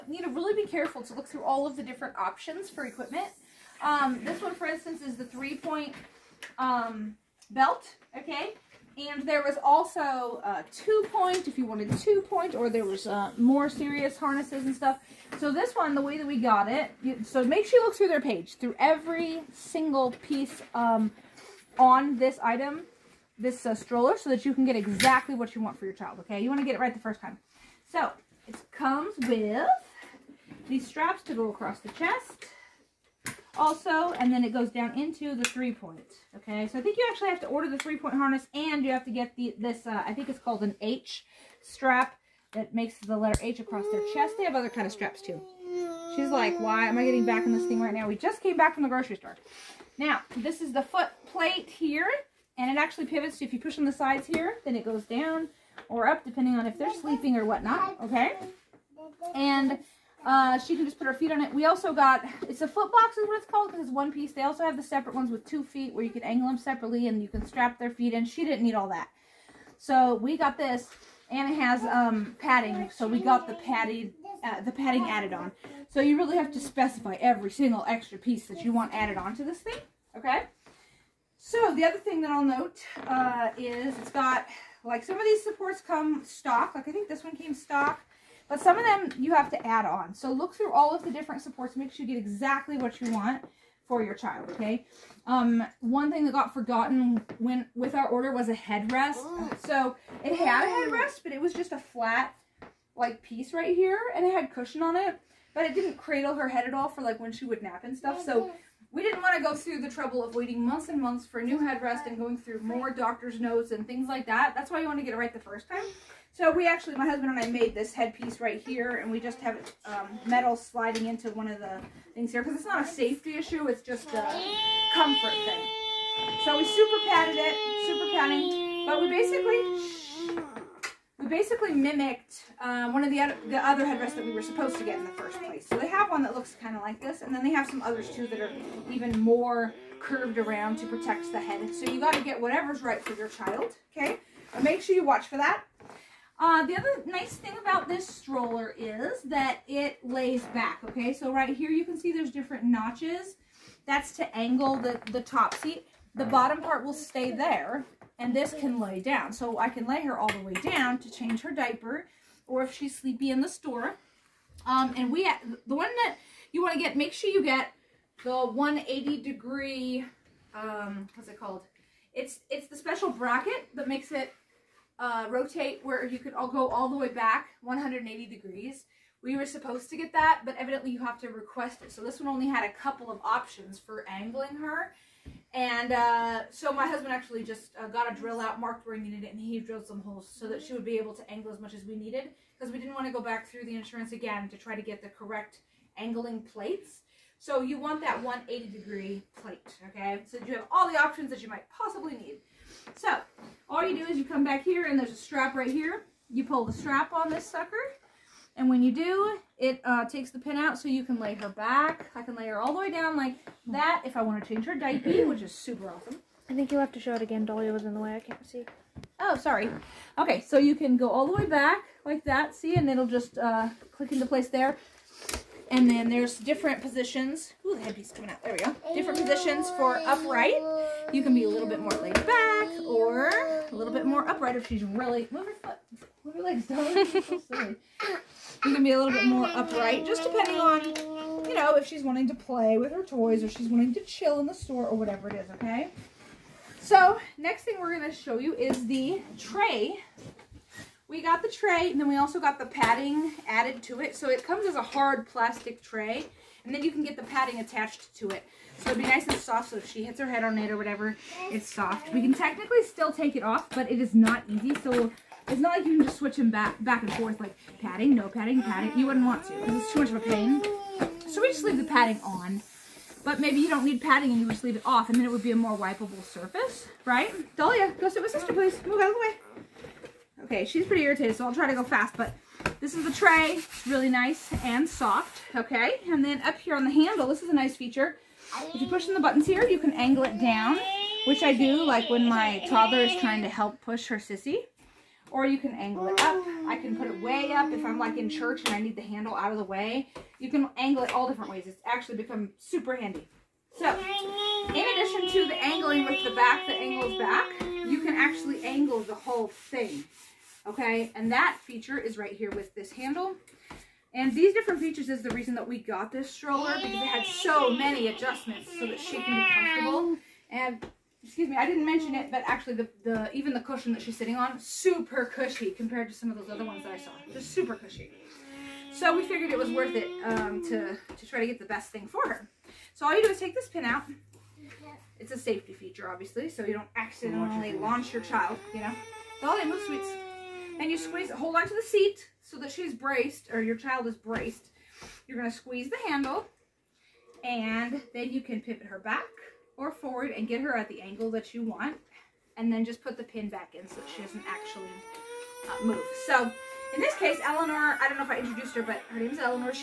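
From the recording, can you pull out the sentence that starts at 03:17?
So you want that 180 degree plate, okay?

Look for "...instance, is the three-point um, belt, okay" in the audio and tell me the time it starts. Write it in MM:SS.
00:04.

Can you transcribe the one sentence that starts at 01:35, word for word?
Um, one thing that got forgotten when with our order was a headrest.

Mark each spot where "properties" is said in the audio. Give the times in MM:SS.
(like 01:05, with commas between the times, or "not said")
not said.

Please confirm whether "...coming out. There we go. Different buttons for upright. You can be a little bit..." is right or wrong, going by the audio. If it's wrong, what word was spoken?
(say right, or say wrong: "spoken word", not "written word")
wrong: "positions", not "buttons".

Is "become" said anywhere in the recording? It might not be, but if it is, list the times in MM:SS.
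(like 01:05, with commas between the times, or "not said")
05:02.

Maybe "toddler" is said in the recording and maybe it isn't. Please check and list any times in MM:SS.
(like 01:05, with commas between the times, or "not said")
04:52.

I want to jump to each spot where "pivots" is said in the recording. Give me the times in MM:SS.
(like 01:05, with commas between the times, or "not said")
00:53, 05:48.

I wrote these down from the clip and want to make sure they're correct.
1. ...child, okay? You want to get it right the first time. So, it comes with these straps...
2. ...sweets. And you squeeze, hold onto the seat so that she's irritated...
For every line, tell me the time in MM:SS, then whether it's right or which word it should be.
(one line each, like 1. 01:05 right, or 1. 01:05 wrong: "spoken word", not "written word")
1. 00:25 right
2. 05:39 wrong: "braced", not "irritated".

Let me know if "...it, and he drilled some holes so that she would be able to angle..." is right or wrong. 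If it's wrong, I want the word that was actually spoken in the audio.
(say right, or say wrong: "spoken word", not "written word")
right.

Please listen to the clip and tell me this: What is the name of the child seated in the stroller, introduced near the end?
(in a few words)
Eleanor.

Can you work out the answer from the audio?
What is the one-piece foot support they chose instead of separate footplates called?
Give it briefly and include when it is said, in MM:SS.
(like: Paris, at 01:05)
foot box, at 01:02.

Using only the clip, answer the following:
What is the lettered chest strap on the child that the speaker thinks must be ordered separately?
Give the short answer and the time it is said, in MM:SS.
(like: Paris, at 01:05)
H strap, at 00:40.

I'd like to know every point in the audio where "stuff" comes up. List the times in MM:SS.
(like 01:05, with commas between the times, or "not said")
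00:14, 01:47.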